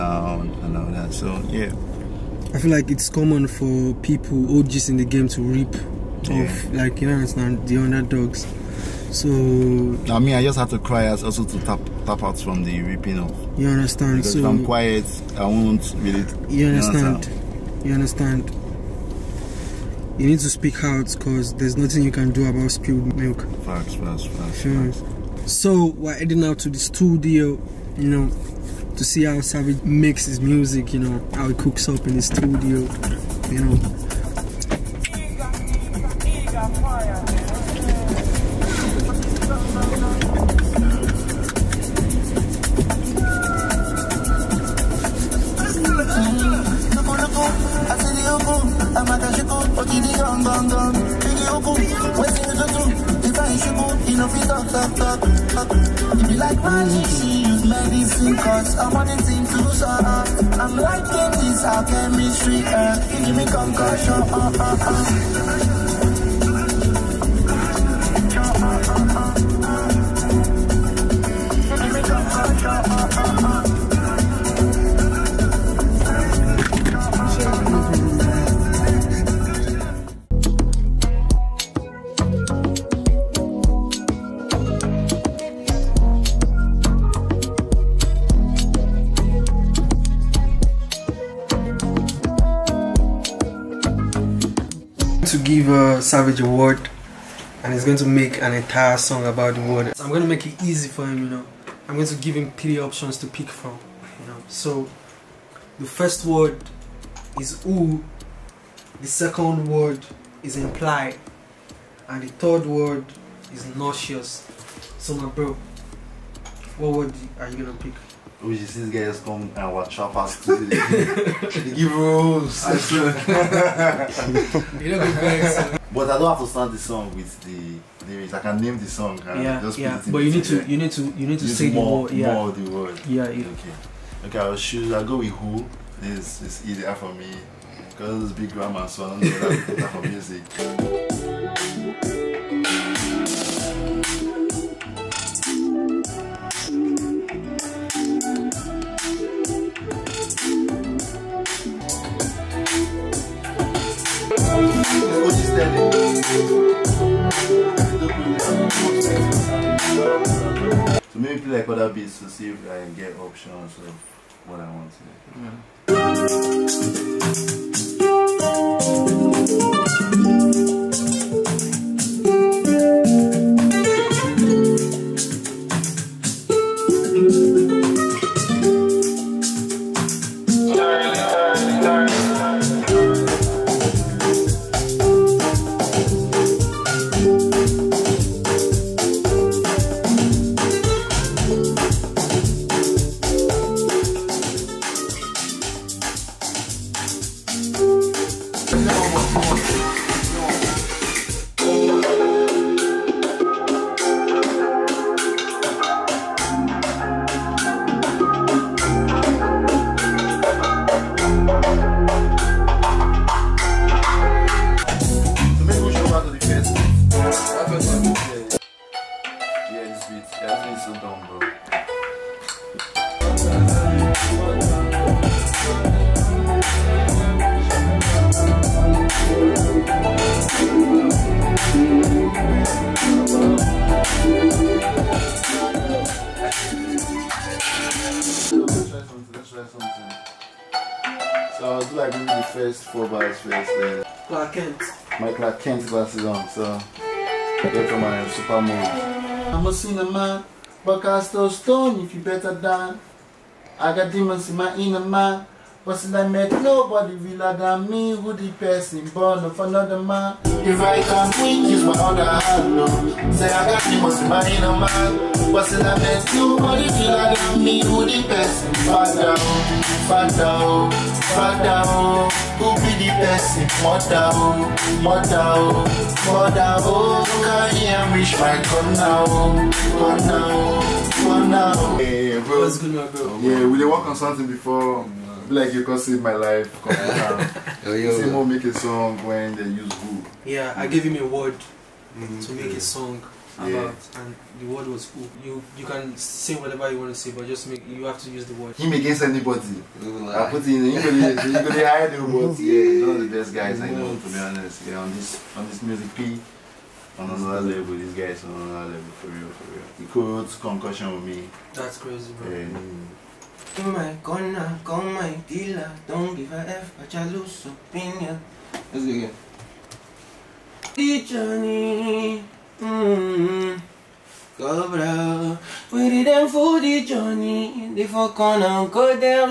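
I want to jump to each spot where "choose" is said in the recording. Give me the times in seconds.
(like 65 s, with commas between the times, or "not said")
134 s.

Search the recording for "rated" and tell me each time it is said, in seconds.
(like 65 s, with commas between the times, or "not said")
not said.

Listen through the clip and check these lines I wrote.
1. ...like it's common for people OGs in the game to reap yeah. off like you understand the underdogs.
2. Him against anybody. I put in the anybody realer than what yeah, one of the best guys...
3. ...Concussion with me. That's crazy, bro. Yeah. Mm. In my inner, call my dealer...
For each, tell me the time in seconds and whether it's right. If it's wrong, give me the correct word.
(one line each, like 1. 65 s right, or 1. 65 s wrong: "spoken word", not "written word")
1. 2 s right
2. 298 s wrong: "higher", not "realer"
3. 310 s wrong: "corner", not "inner".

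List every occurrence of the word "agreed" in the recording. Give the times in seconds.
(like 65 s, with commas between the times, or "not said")
not said.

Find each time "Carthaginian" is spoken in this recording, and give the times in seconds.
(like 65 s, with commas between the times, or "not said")
not said.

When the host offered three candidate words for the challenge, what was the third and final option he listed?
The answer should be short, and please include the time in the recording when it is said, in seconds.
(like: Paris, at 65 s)
nauseous, at 113 s.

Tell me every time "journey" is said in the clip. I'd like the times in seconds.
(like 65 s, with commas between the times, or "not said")
321 s, 327 s.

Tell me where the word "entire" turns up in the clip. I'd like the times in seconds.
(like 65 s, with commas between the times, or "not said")
98 s.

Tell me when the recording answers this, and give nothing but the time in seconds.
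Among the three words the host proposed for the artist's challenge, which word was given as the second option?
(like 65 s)
110 s.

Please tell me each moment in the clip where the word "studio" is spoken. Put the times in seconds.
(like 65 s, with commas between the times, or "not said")
26 s, 32 s.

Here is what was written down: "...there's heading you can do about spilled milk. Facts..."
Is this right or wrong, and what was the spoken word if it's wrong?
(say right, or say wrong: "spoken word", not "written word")
wrong: "nothing", not "heading".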